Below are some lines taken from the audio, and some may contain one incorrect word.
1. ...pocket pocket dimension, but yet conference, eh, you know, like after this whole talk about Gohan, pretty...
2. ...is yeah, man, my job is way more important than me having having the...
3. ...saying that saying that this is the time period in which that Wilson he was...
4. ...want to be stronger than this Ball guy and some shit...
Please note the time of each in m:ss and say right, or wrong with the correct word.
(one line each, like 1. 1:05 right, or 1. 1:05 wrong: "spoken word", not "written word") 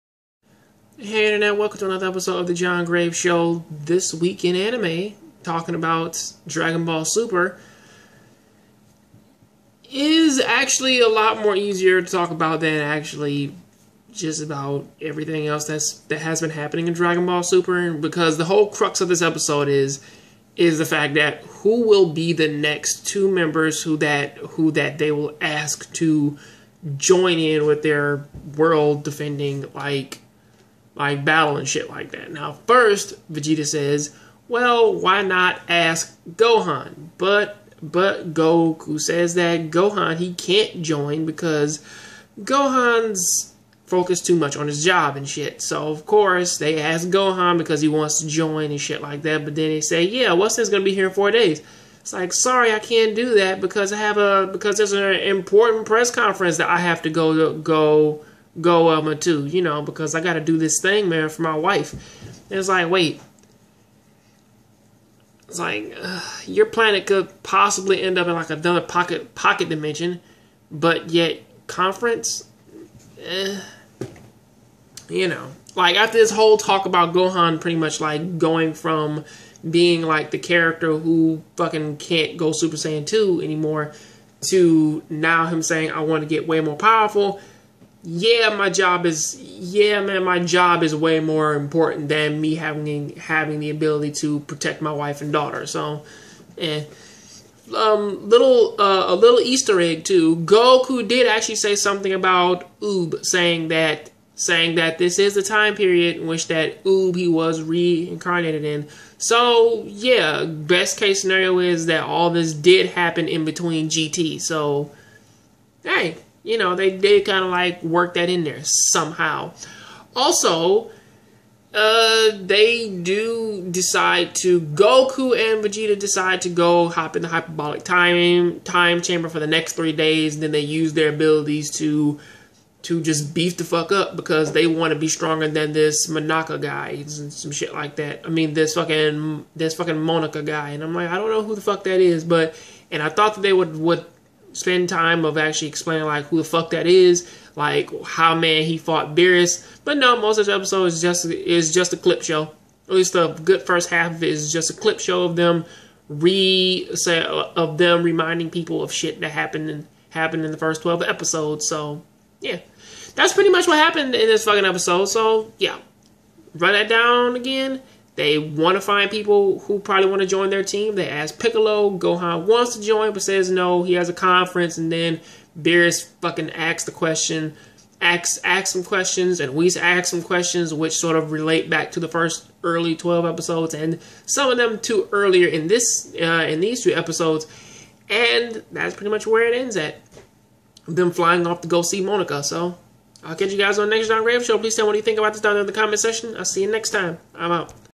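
1. 1:08 right
2. 1:29 right
3. 1:43 wrong: "Oob", not "Wilson"
4. 2:14 wrong: "Monaka", not "Ball".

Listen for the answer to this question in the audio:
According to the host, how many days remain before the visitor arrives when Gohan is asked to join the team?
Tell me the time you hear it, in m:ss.
0:51.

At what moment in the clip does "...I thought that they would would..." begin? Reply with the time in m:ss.
2:23.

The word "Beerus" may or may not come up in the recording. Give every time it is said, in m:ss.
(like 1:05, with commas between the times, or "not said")
2:29, 2:55.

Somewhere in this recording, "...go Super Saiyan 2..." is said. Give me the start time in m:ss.
1:22.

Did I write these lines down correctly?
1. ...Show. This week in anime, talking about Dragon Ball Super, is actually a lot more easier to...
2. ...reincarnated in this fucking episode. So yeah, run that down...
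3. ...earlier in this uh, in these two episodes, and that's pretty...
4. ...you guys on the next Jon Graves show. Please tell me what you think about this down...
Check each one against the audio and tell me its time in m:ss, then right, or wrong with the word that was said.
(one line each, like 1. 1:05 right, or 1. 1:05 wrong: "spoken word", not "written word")
1. 0:03 right
2. 2:43 wrong: "happened", not "reincarnated"
3. 3:05 right
4. 3:13 right.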